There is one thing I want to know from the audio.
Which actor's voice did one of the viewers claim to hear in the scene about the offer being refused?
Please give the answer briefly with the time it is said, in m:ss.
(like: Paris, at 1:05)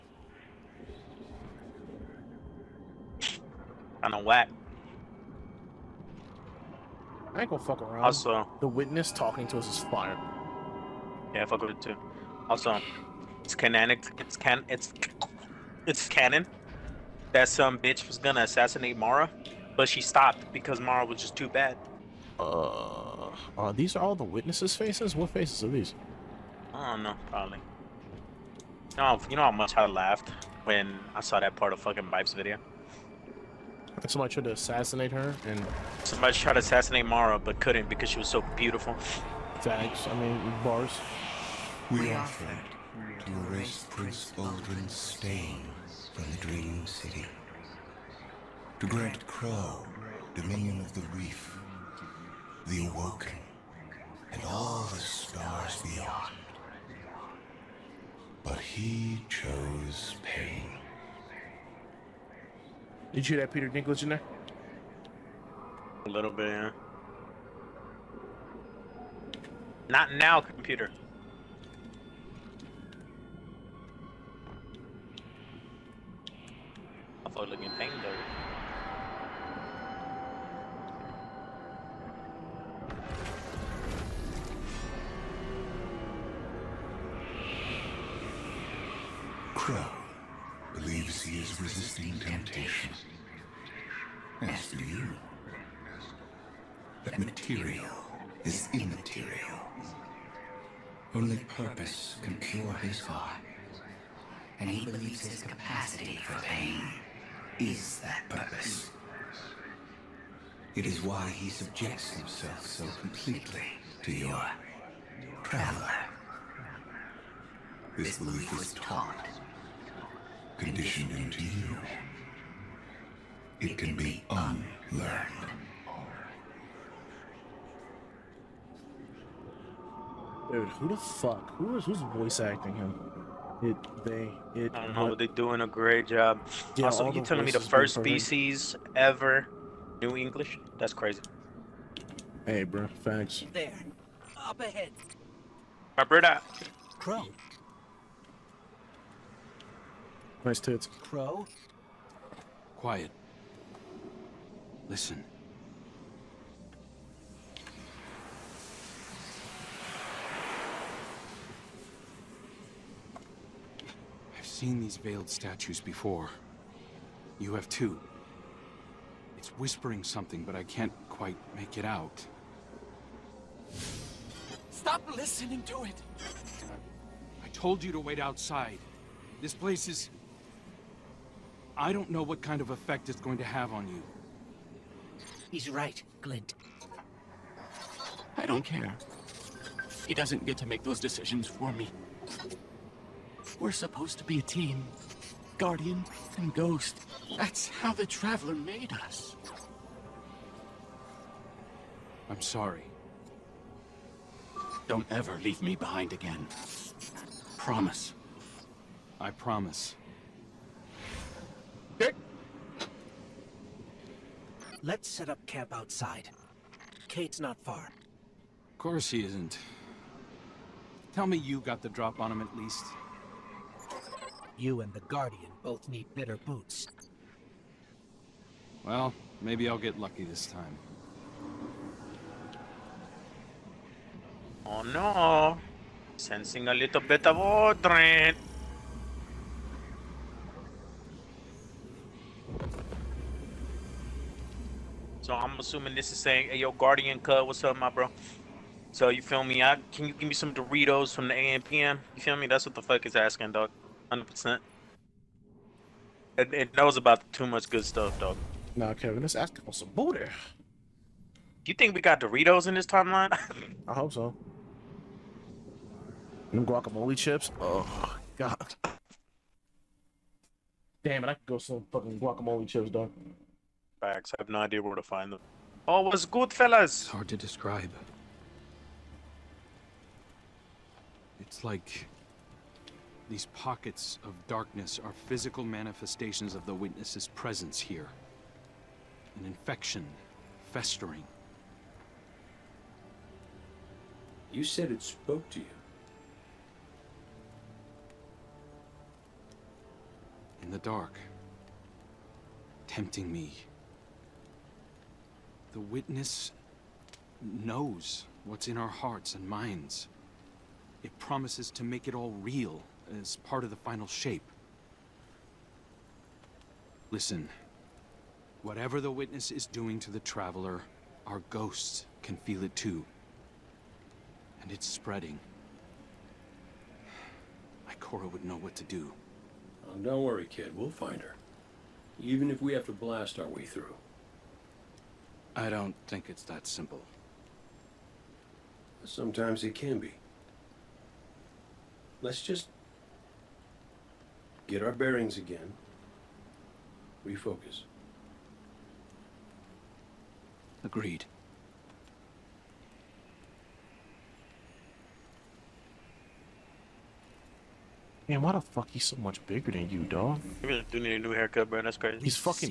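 Peter Dinklage, at 1:03.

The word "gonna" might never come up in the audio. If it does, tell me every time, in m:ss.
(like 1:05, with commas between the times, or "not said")
0:07, 0:18.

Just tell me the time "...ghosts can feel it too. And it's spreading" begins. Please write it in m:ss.
5:21.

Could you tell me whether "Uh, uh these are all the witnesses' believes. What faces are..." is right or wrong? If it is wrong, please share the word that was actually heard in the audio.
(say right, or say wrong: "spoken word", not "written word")
wrong: "faces", not "believes".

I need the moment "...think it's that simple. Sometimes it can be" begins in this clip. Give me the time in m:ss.
5:36.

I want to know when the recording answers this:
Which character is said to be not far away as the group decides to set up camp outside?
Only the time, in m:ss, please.
3:37.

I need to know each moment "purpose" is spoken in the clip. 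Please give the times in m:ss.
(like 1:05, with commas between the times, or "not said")
1:41, 1:48.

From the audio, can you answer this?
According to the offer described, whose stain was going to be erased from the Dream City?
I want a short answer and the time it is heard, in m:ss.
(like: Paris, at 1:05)
Prince Uldren, at 0:43.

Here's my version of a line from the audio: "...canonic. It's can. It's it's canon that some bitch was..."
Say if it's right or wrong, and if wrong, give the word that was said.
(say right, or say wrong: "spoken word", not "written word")
right.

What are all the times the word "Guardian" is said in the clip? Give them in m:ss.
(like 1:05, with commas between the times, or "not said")
3:15, 3:45, 4:06.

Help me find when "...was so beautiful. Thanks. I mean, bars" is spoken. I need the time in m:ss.
0:38.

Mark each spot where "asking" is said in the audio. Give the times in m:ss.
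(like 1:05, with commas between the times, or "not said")
4:13, 4:19.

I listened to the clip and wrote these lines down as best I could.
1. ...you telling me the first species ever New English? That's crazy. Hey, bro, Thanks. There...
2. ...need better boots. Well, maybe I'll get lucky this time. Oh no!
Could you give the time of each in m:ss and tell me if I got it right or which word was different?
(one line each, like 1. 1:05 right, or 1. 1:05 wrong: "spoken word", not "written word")
1. 2:17 right
2. 3:45 right.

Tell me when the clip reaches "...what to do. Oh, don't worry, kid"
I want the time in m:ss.
5:28.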